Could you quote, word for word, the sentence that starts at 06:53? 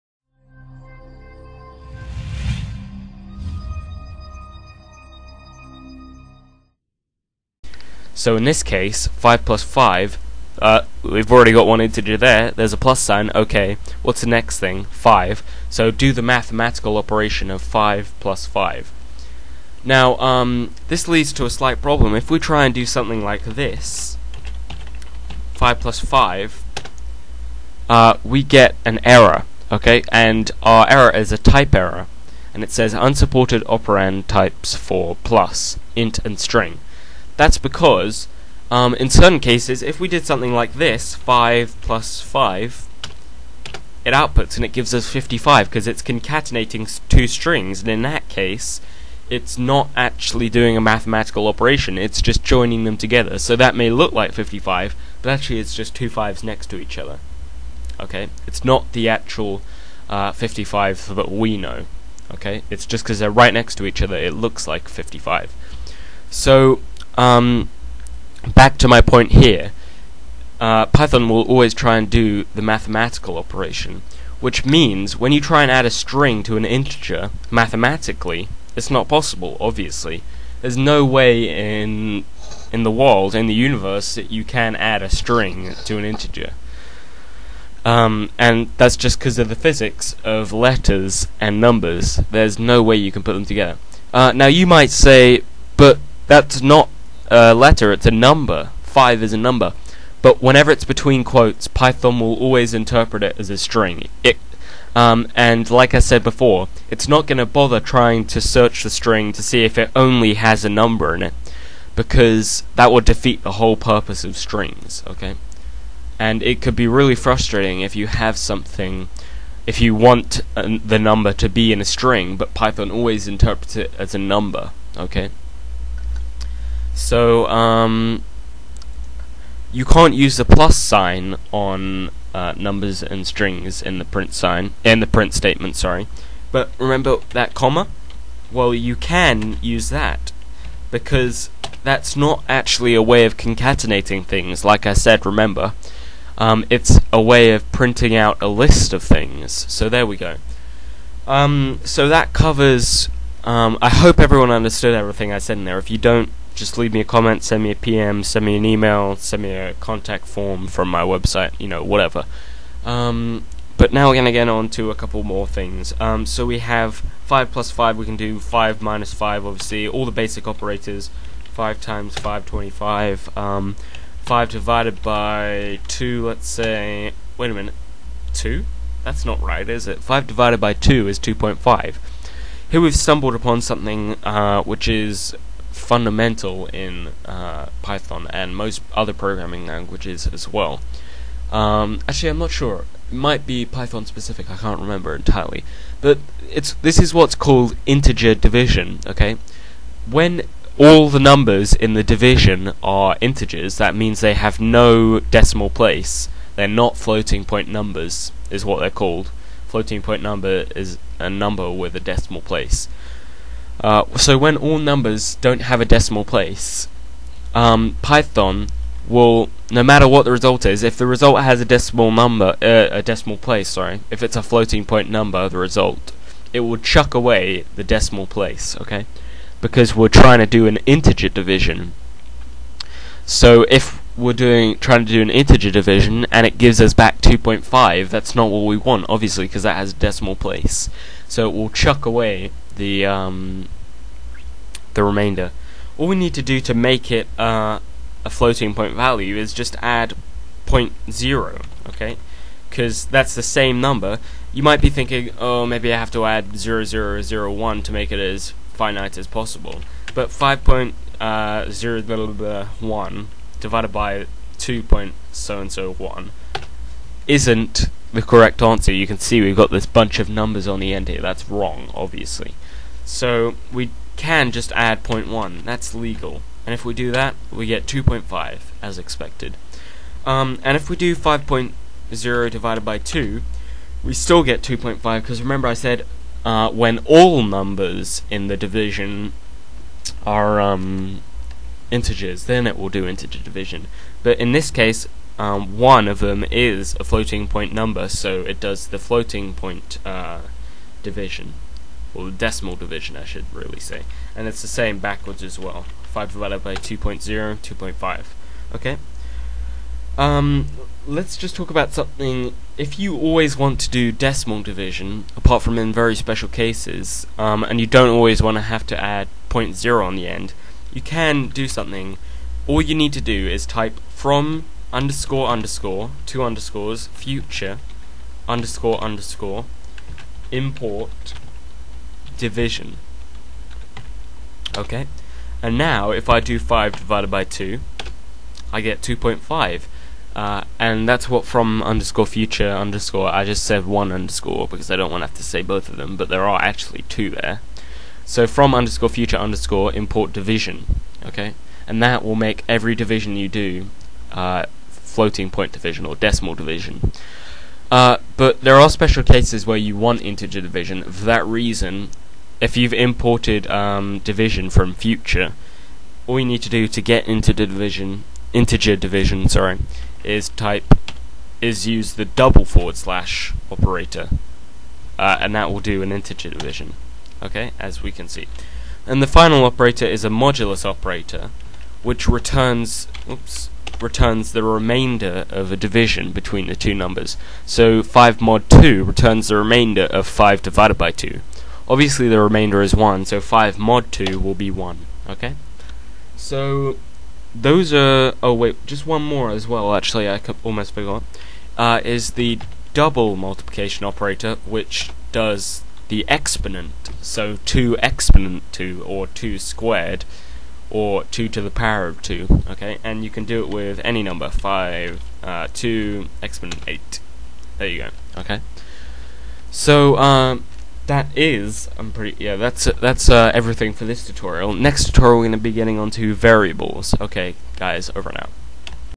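And you can do it with any number, 5, uh, 2, exponent 8.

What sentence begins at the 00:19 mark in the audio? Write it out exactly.
Now, um, this leads to a slight problem.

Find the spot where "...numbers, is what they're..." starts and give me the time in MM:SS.
03:27.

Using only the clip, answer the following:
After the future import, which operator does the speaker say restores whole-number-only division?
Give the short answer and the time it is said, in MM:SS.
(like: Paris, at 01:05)
double forward slash, at 06:12.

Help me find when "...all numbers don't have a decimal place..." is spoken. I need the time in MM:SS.
03:34.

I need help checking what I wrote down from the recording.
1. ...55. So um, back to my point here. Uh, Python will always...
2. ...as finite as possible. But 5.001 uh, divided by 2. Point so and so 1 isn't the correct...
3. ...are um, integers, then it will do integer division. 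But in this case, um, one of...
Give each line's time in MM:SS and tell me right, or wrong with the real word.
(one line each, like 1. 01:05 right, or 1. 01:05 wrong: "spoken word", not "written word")
1. 01:04 right
2. 04:18 right
3. 04:50 right.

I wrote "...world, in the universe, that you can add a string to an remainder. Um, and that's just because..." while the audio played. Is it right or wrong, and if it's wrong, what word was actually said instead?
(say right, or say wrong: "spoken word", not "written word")
wrong: "integer", not "remainder".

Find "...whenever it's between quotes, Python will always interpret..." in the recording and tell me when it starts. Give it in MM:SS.
01:40.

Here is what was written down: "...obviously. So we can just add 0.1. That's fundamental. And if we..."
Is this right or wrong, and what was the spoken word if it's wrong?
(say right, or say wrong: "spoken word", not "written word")
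wrong: "legal", not "fundamental".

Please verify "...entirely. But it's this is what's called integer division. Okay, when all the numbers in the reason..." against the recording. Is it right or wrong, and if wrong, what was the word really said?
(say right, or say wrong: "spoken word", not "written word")
wrong: "division", not "reason".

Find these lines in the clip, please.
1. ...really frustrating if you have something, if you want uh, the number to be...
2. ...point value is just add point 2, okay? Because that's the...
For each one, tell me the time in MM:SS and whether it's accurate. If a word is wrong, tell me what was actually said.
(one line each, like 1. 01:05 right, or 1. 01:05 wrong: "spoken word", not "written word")
1. 01:56 right
2. 04:08 wrong: "0", not "2".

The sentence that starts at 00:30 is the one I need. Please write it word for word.
And our error is a type error, and it says unsupported operand types for plus, int and string.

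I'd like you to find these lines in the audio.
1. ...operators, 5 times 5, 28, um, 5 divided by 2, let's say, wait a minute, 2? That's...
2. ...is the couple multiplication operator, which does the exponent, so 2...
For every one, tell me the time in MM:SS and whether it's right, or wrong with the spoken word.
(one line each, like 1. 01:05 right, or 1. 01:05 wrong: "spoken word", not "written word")
1. 02:50 wrong: "25", not "28"
2. 06:42 wrong: "double", not "couple".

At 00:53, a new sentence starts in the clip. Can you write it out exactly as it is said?
So that may look like 55, but actually it's just two fives next to each other.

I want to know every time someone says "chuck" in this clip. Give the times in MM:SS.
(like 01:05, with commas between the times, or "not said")
03:46, 04:01.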